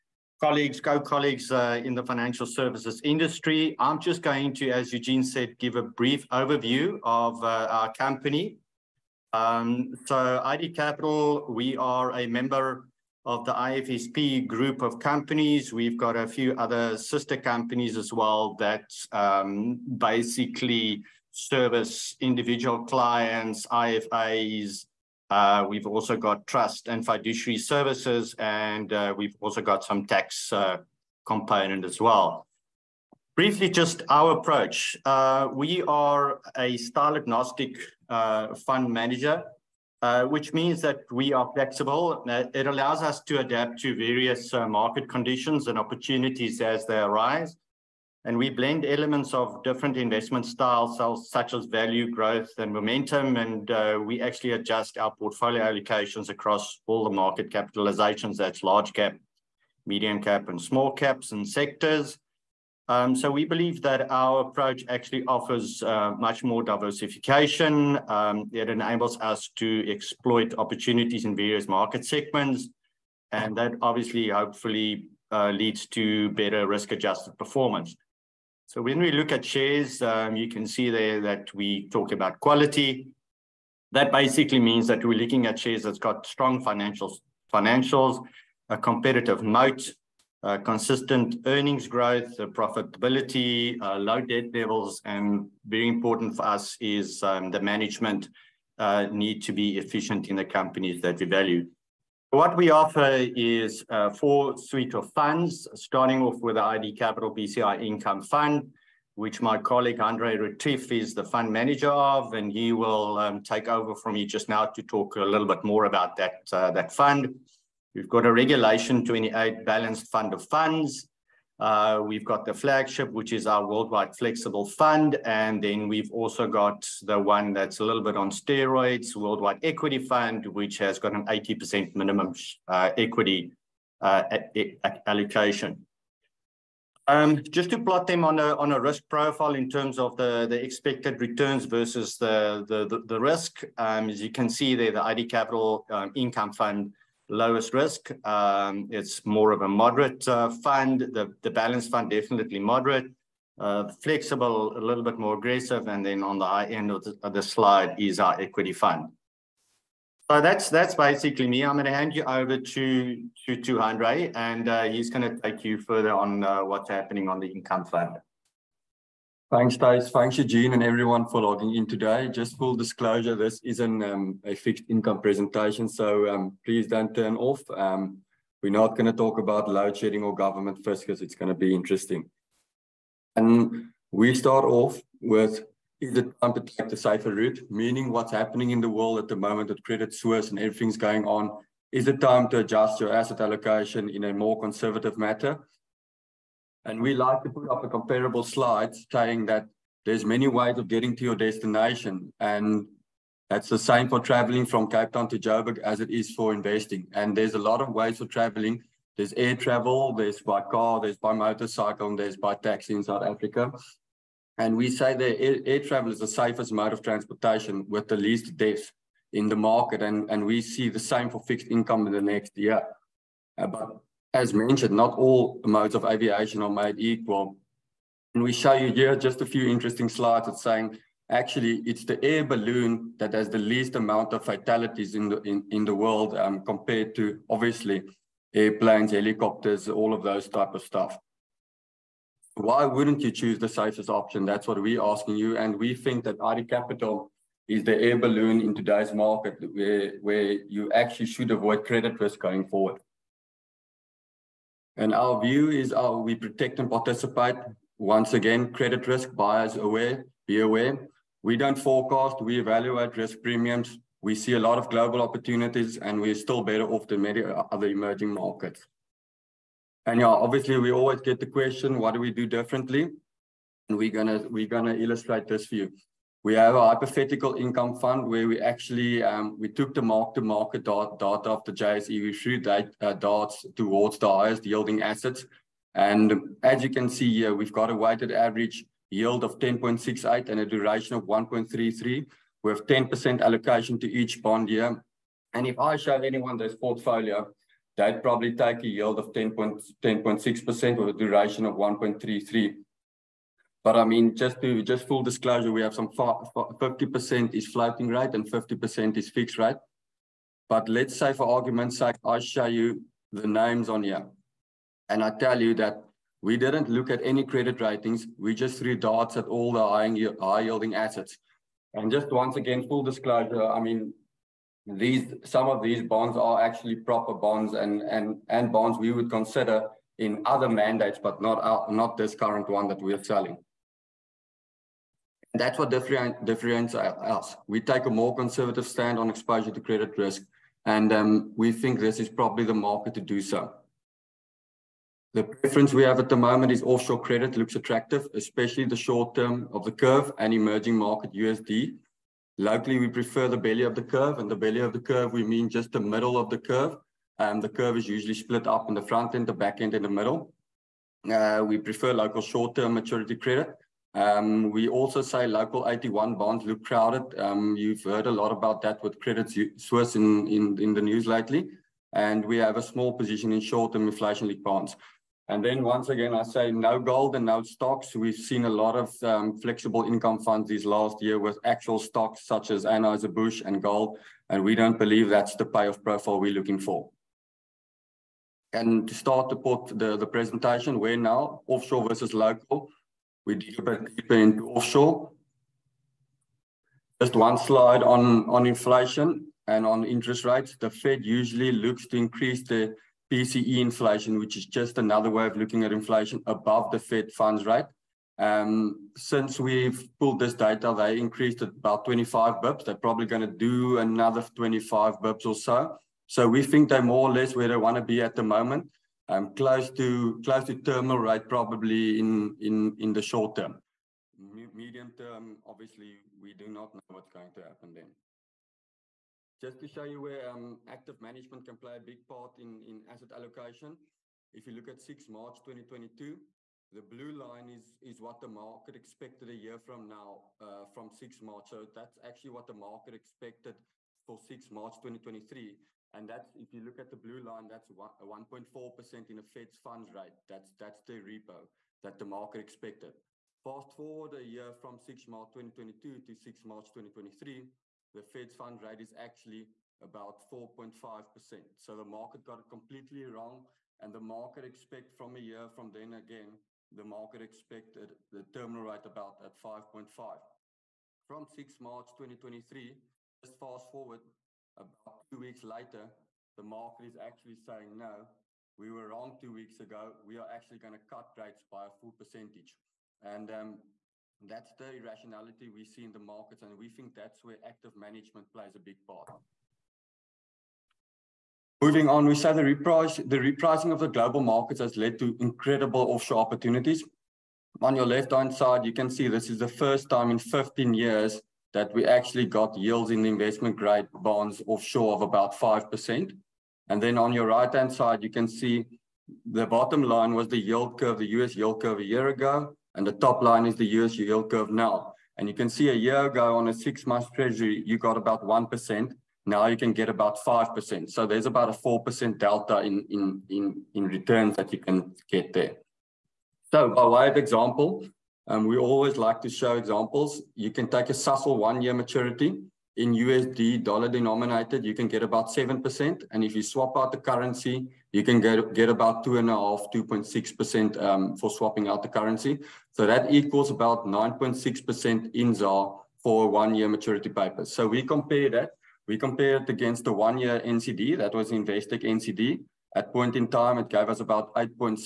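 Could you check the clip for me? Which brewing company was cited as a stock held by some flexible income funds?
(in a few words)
Anheuser-Busch.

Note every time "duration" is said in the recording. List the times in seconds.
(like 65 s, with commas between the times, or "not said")
290 s, 301 s.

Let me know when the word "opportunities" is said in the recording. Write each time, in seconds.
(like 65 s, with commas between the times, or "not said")
45 s, 70 s, 265 s, 496 s.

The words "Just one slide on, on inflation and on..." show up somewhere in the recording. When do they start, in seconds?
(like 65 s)
397 s.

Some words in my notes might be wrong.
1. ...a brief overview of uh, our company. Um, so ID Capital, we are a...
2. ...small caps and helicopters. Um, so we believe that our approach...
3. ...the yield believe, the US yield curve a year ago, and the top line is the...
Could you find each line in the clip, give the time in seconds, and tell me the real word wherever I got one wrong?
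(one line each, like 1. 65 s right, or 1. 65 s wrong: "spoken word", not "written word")
1. 5 s right
2. 60 s wrong: "sectors", not "helicopters"
3. 510 s wrong: "curve", not "believe".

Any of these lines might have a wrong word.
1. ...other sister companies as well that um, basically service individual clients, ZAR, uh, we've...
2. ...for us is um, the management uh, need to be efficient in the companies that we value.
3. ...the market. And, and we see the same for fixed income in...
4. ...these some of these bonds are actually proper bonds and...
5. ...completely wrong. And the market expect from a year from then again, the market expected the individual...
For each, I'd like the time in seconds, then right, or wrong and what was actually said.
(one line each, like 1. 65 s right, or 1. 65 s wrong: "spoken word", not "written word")
1. 16 s wrong: "IFAs", not "ZAR"
2. 96 s right
3. 219 s right
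4. 324 s right
5. 462 s wrong: "terminal", not "individual".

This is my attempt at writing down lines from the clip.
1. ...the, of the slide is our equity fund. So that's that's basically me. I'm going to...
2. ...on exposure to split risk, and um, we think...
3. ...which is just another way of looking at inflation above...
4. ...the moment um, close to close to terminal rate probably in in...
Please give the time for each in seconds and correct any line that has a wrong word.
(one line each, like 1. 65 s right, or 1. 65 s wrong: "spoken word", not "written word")
1. 157 s right
2. 339 s wrong: "credit", not "split"
3. 404 s right
4. 418 s right.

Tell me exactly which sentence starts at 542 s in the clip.
So that equals about 9.6% in ZAR for one-year maturity paper.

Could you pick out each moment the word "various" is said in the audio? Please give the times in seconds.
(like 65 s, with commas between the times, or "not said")
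43 s, 71 s.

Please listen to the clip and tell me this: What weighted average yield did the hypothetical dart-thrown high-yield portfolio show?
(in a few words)
10.68.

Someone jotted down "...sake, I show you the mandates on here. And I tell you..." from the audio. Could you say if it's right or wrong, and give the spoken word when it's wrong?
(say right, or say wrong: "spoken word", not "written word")
wrong: "names", not "mandates".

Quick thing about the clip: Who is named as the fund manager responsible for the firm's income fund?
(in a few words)
Andre Retief.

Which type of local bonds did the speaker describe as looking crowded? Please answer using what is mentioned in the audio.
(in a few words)
AT1 bonds.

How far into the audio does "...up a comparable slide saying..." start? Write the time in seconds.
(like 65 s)
197 s.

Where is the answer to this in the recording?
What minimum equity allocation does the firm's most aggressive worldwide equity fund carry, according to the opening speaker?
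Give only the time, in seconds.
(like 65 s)
131 s.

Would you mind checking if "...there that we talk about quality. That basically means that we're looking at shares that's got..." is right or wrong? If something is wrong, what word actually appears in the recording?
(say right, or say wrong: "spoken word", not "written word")
right.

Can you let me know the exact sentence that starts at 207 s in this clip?
And there's a lot of ways for traveling.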